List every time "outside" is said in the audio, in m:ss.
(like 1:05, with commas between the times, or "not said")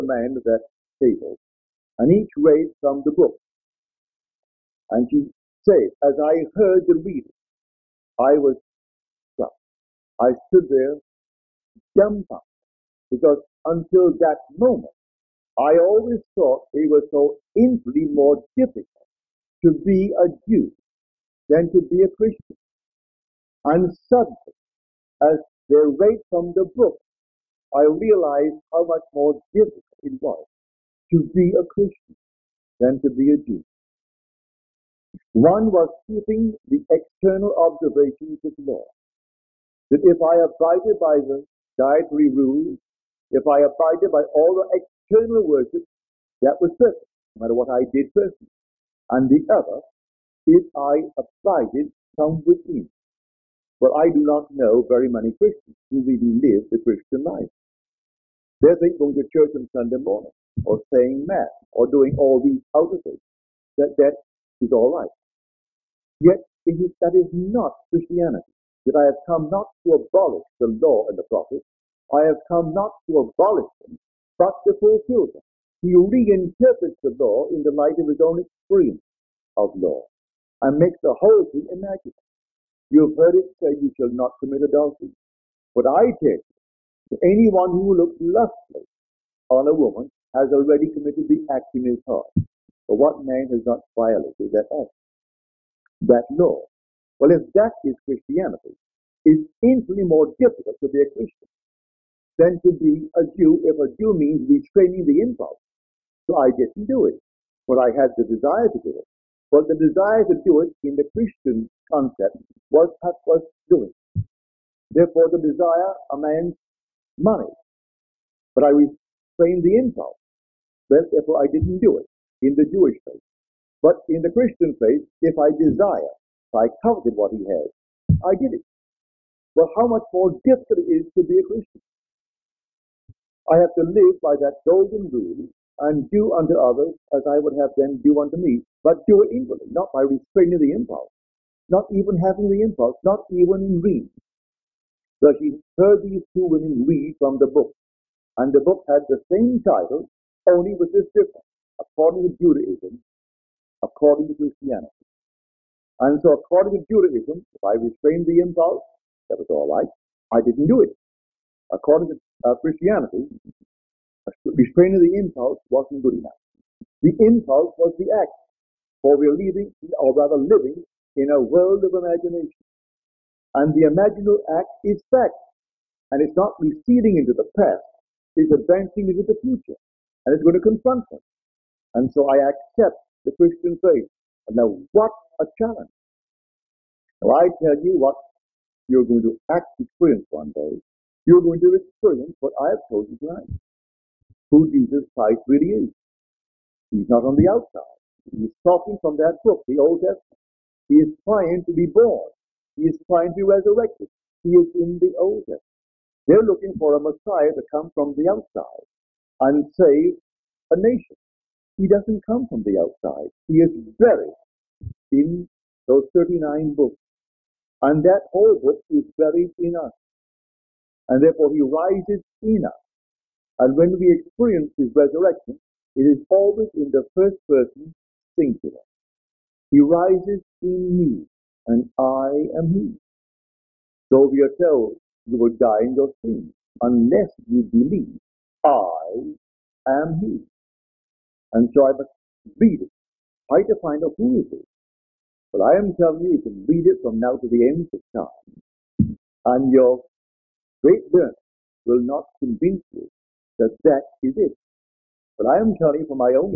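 3:17, 3:28, 3:32.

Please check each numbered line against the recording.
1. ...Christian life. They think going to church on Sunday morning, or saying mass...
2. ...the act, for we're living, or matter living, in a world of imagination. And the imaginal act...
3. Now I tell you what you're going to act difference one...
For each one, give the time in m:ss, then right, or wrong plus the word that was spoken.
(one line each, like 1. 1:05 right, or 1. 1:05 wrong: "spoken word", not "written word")
1. 0:56 right
2. 2:47 wrong: "rather", not "matter"
3. 3:07 wrong: "experience", not "difference".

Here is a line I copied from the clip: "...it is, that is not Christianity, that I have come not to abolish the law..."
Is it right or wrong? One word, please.
right.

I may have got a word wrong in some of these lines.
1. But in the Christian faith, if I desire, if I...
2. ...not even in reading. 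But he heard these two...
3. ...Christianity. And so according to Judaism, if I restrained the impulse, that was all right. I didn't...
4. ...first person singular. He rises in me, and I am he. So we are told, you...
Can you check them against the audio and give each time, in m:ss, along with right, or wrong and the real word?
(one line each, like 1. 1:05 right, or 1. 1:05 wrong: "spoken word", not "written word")
1. 2:03 right
2. 2:23 right
3. 2:34 right
4. 3:47 right.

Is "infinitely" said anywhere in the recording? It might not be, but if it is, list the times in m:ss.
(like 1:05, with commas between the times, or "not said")
0:17, 1:39.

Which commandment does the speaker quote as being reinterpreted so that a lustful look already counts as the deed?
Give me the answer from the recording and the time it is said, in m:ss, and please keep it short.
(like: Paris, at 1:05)
You shall not commit adultery, at 1:23.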